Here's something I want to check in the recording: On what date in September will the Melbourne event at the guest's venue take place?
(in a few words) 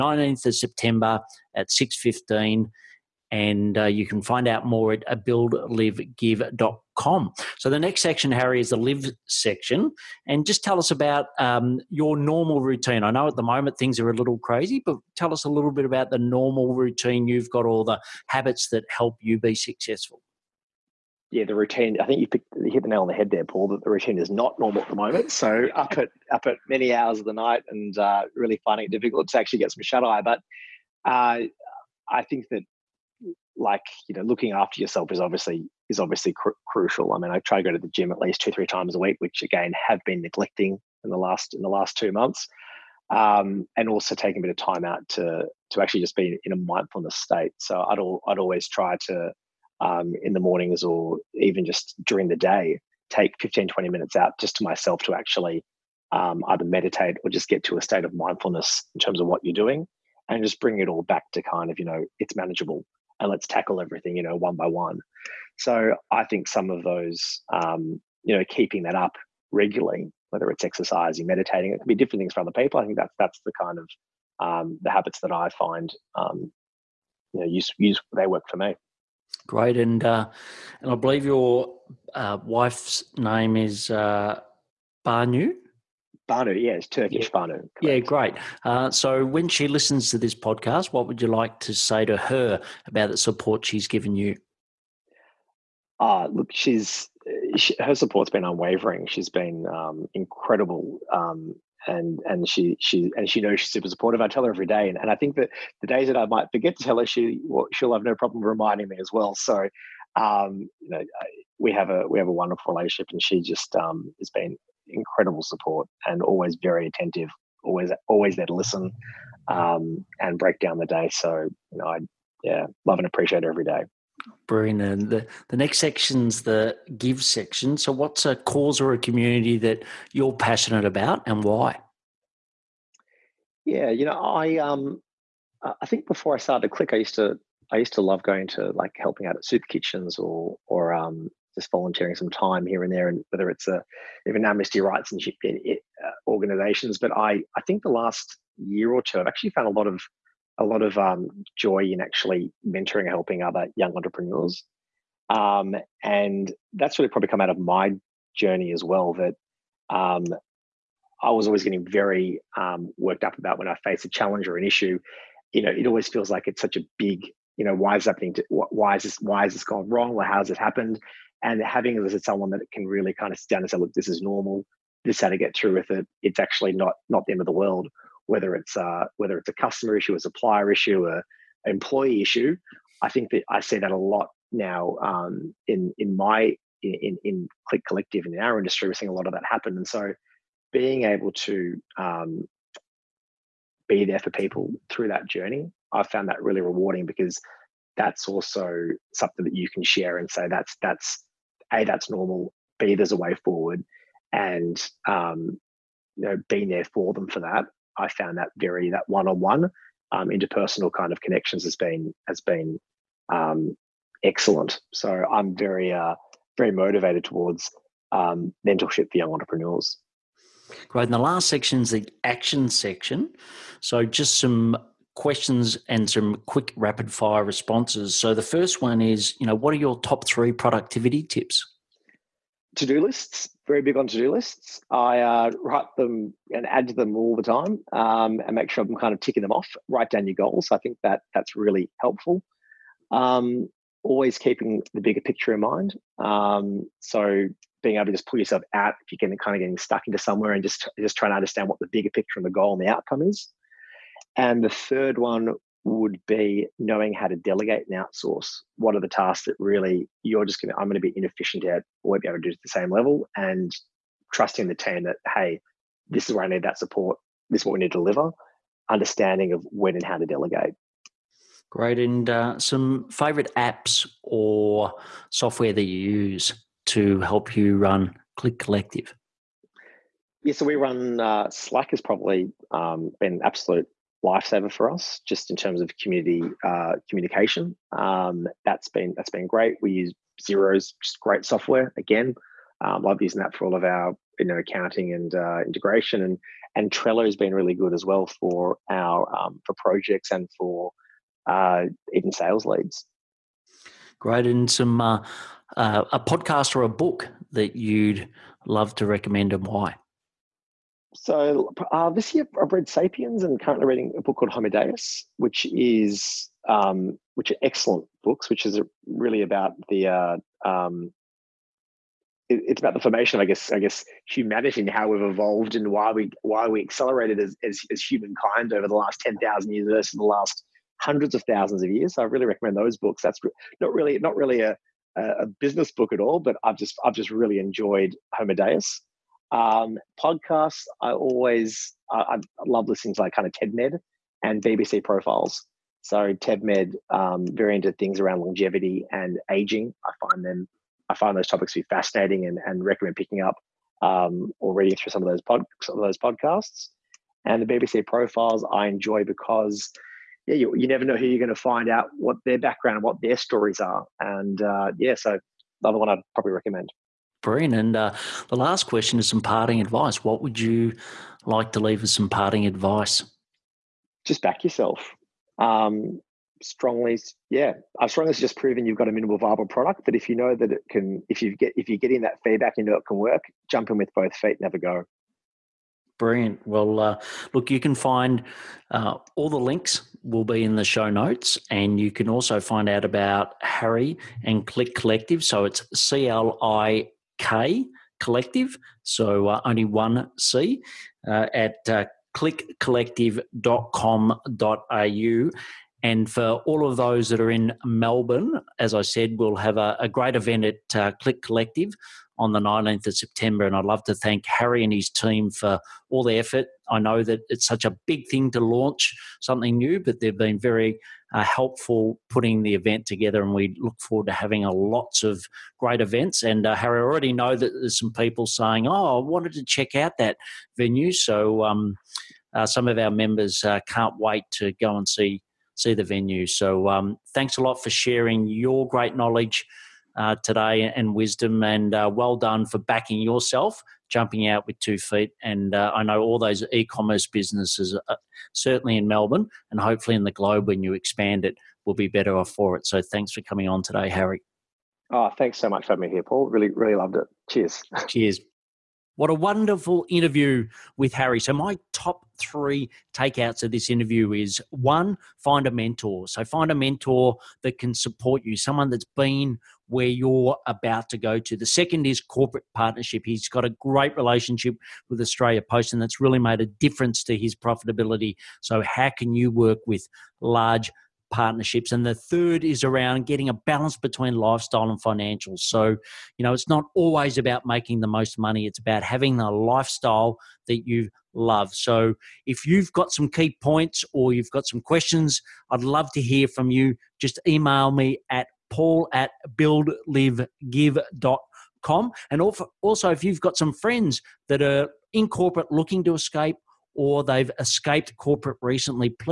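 19th of September.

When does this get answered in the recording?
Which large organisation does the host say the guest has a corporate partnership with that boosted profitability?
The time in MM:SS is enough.
07:55.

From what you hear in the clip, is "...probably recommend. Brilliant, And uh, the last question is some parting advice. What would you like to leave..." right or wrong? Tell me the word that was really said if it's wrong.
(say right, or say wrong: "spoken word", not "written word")
right.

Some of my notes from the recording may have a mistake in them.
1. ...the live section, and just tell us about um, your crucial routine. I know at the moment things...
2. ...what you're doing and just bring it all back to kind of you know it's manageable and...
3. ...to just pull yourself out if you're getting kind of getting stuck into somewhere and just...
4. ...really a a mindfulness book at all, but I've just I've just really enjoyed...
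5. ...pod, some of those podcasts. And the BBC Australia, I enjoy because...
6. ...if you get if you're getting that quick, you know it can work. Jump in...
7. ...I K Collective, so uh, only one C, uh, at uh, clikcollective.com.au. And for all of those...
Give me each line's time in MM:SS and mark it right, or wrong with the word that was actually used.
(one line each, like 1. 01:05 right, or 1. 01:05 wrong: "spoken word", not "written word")
1. 00:08 wrong: "normal", not "crucial"
2. 00:59 right
3. 04:08 right
4. 05:34 wrong: "business", not "mindfulness"
5. 05:55 wrong: "Profiles", not "Australia"
6. 06:21 wrong: "feedback", not "quick"
7. 06:36 right.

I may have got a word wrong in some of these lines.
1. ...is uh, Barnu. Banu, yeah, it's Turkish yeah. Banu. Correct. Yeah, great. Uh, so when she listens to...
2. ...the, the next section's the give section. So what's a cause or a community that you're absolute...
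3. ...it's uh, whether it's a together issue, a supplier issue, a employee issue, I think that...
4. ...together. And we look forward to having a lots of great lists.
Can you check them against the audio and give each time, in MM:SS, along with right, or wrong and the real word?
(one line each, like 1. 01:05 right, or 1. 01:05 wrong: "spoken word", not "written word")
1. 01:23 right
2. 02:05 wrong: "passionate", not "absolute"
3. 02:58 wrong: "customer", not "together"
4. 07:03 wrong: "events", not "lists".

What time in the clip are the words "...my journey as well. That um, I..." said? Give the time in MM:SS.
02:37.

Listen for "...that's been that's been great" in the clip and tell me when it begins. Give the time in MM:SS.
04:48.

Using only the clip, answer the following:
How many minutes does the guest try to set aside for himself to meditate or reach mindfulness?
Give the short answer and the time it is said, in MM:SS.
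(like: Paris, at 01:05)
15 20 minutes, at 00:53.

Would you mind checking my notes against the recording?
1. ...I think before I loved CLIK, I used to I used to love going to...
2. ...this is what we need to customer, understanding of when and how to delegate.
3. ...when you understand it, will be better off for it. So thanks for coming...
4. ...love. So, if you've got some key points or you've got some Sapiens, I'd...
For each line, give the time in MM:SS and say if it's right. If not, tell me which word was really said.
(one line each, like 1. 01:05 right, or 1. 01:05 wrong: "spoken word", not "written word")
1. 02:15 wrong: "started", not "loved"
2. 04:27 wrong: "deliver", not "customer"
3. 07:30 wrong: "expand", not "understand"
4. 08:11 wrong: "questions", not "Sapiens".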